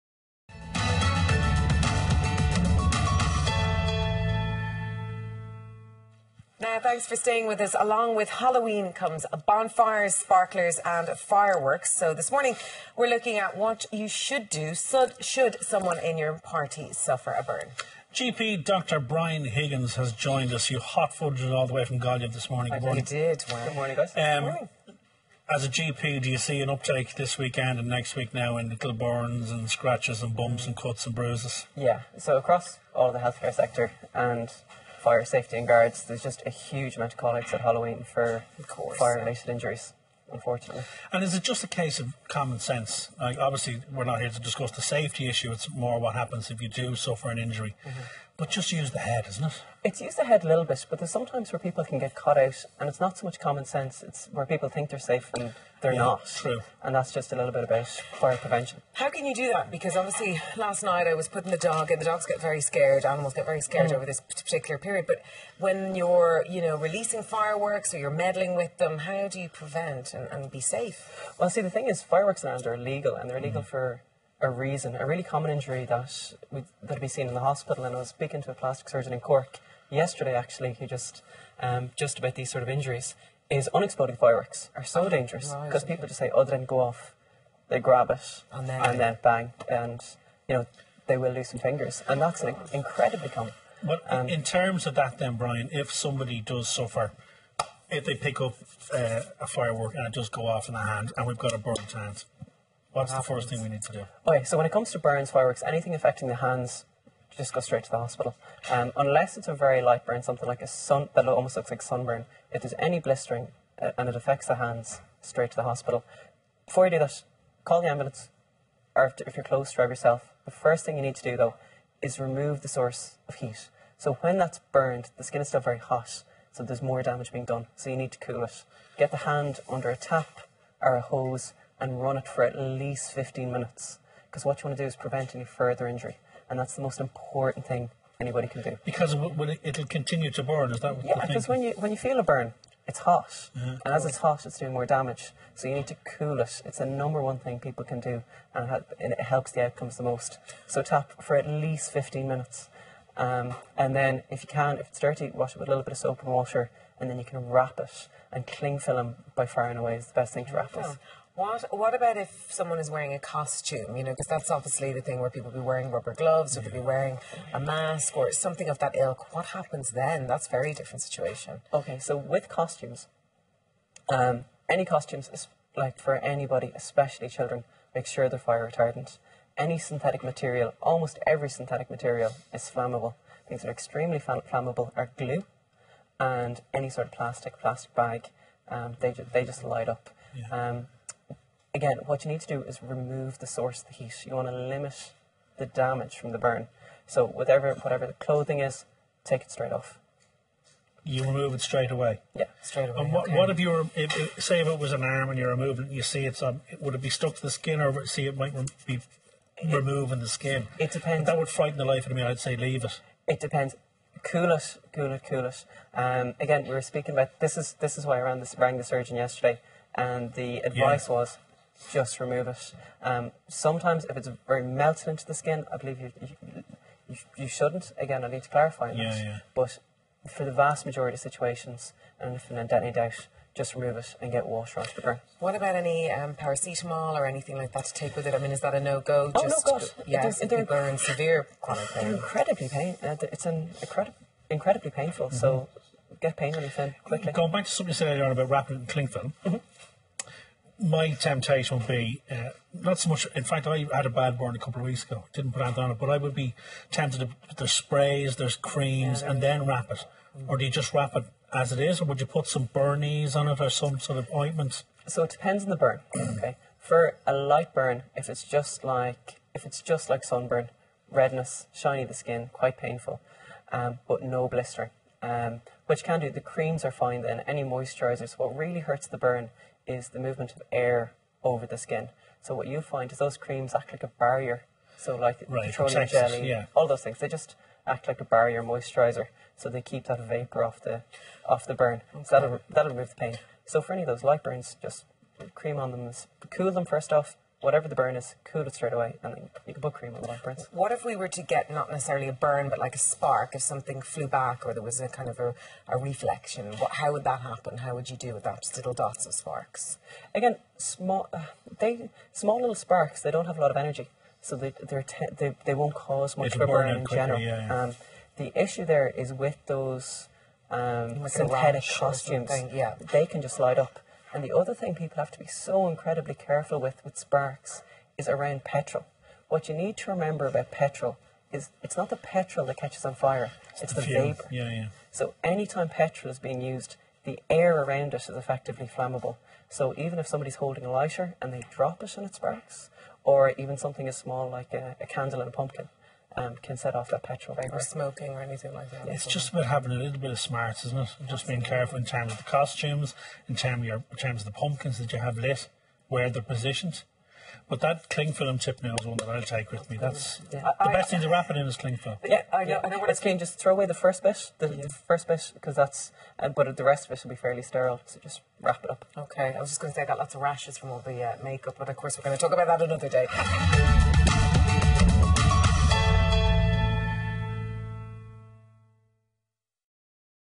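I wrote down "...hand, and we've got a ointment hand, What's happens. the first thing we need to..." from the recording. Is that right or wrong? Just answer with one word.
wrong.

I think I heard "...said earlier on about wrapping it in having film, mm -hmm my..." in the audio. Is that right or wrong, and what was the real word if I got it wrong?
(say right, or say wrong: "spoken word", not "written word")
wrong: "cling", not "having".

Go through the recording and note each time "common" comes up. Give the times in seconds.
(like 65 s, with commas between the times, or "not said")
42 s, 53 s, 75 s, 93 s.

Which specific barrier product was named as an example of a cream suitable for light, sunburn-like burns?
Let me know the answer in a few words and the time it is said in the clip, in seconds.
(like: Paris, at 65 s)
Petroleum jelly, at 285 s.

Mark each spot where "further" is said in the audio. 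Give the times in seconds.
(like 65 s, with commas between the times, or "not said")
135 s.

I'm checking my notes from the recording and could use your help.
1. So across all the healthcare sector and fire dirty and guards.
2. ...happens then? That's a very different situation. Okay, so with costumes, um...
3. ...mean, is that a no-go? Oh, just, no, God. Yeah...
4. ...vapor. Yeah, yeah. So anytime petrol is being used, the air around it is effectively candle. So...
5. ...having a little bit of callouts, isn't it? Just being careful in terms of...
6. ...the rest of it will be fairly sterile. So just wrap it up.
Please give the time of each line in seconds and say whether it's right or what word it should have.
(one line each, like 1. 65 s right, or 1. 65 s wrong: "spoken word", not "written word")
1. 32 s wrong: "safety", not "dirty"
2. 169 s right
3. 238 s right
4. 334 s wrong: "flammable", not "candle"
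5. 349 s wrong: "smarts", not "callouts"
6. 366 s right.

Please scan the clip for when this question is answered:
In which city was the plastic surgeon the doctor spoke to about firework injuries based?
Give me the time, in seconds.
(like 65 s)
79 s.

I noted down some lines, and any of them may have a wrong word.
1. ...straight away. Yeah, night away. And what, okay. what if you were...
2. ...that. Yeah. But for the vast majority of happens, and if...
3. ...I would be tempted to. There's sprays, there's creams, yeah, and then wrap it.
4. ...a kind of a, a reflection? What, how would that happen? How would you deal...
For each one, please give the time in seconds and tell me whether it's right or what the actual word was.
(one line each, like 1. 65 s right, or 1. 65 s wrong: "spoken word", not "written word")
1. 201 s wrong: "straight", not "night"
2. 229 s wrong: "situations", not "happens"
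3. 256 s right
4. 304 s right.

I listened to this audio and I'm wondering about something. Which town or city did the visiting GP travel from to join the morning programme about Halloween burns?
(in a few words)
Galway.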